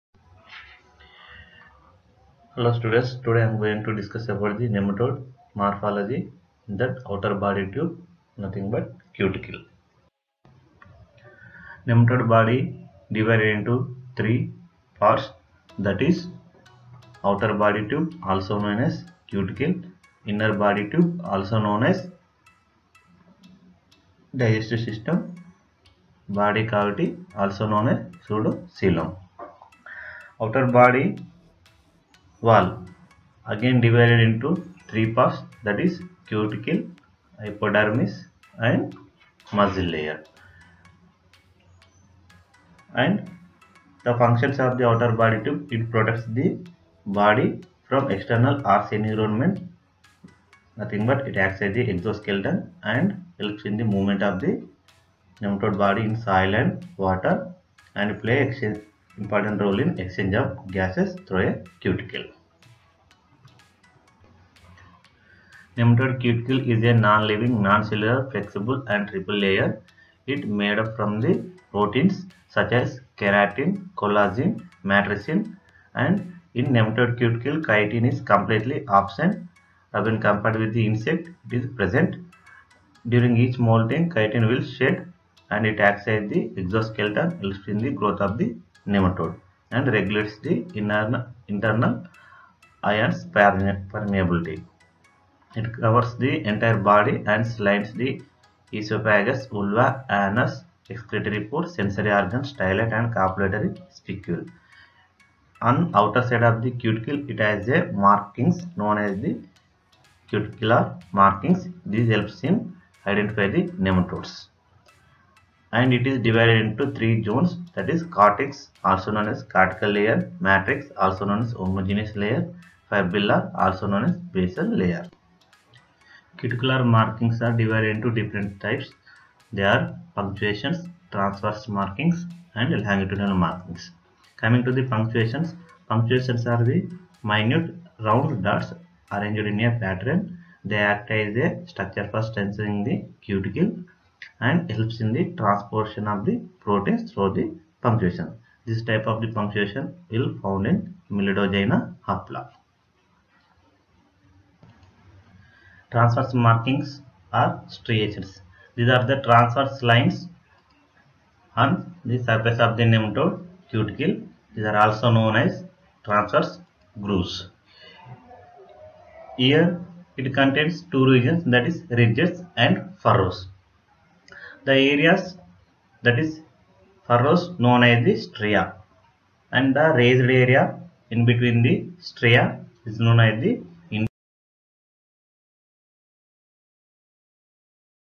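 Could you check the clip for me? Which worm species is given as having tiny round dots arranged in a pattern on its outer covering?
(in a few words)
Meloidogyne hapla.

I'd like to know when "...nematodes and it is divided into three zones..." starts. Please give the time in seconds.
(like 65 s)
113 s.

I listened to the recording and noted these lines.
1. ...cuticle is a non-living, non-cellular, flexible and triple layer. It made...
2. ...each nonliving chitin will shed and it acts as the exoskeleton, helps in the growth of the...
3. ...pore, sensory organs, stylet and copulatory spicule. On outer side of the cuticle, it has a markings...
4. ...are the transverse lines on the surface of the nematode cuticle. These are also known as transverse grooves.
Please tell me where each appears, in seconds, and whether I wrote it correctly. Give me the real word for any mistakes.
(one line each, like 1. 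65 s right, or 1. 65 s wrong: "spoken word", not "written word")
1. 66 s right
2. 83 s wrong: "molting", not "nonliving"
3. 101 s right
4. 158 s right.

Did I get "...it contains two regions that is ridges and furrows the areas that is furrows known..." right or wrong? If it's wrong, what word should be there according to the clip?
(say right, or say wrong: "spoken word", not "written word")
right.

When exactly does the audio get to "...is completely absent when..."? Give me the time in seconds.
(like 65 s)
78 s.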